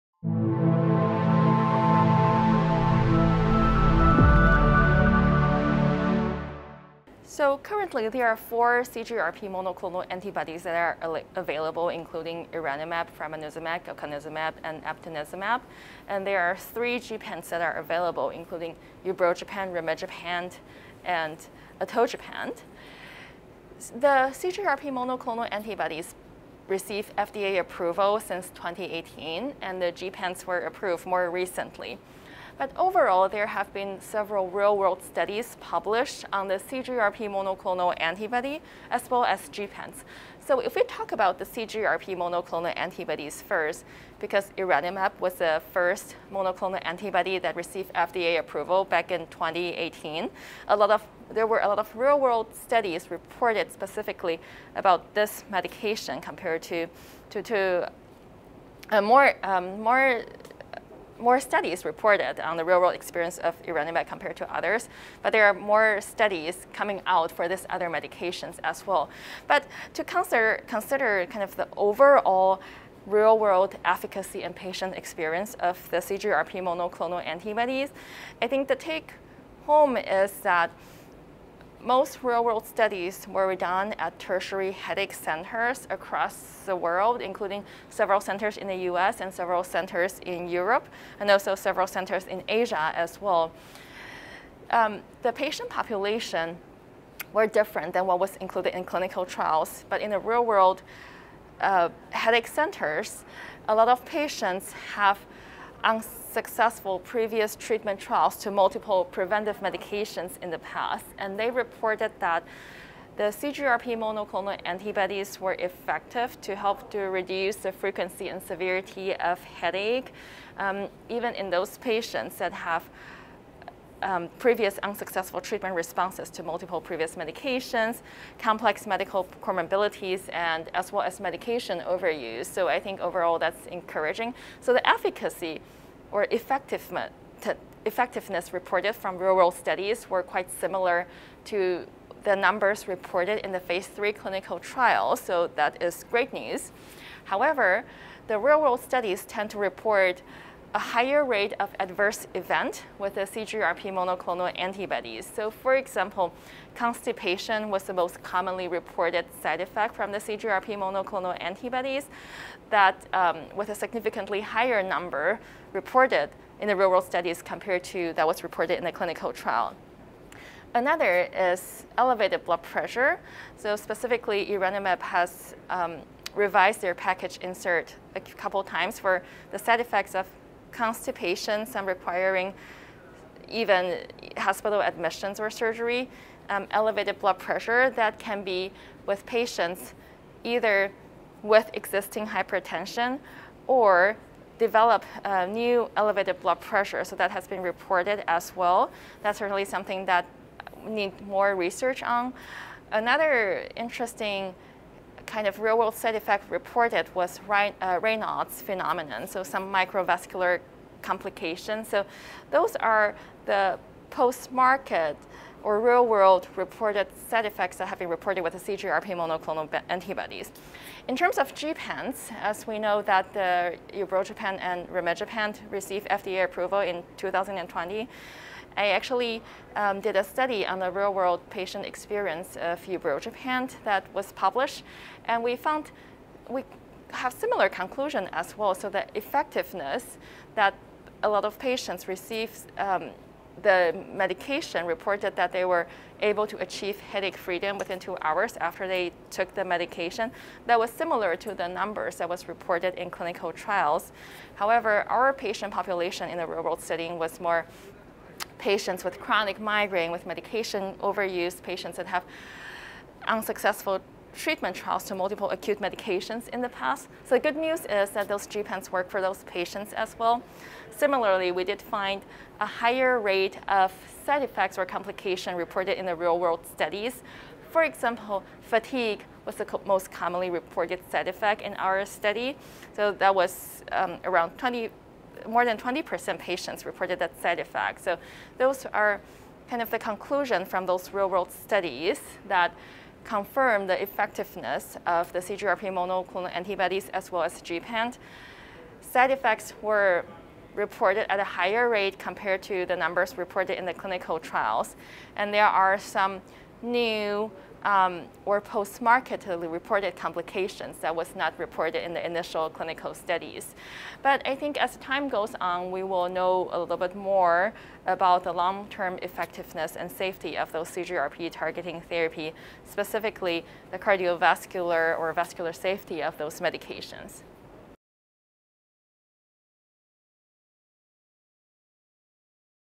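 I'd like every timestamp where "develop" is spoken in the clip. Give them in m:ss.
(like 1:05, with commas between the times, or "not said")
3:14.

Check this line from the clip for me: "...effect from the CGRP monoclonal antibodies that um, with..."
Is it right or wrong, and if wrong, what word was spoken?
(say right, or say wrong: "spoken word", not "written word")
right.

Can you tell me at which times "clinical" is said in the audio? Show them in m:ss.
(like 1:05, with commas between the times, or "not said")
1:38, 2:24, 2:48, 4:13, 5:03, 5:12.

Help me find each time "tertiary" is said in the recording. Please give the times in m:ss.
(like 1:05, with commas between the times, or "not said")
1:24.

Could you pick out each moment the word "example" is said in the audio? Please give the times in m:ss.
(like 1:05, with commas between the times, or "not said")
2:35, 4:37.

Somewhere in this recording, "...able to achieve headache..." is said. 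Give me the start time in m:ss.
4:06.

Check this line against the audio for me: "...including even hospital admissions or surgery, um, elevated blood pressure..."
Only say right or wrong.
wrong.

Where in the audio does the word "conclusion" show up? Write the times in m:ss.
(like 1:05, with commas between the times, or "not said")
3:57, 4:49.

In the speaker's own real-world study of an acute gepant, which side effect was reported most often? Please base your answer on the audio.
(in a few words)
fatigue.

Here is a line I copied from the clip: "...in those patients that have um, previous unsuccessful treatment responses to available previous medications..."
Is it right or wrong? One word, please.
wrong.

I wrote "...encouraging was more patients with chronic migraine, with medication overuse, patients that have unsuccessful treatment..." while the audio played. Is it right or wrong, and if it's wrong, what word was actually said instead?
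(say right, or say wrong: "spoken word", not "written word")
wrong: "setting", not "encouraging".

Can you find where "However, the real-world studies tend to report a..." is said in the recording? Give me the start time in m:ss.
2:27.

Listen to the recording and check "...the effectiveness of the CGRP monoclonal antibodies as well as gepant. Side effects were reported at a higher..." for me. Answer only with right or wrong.
right.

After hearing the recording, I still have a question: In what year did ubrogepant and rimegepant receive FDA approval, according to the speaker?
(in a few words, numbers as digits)
2020.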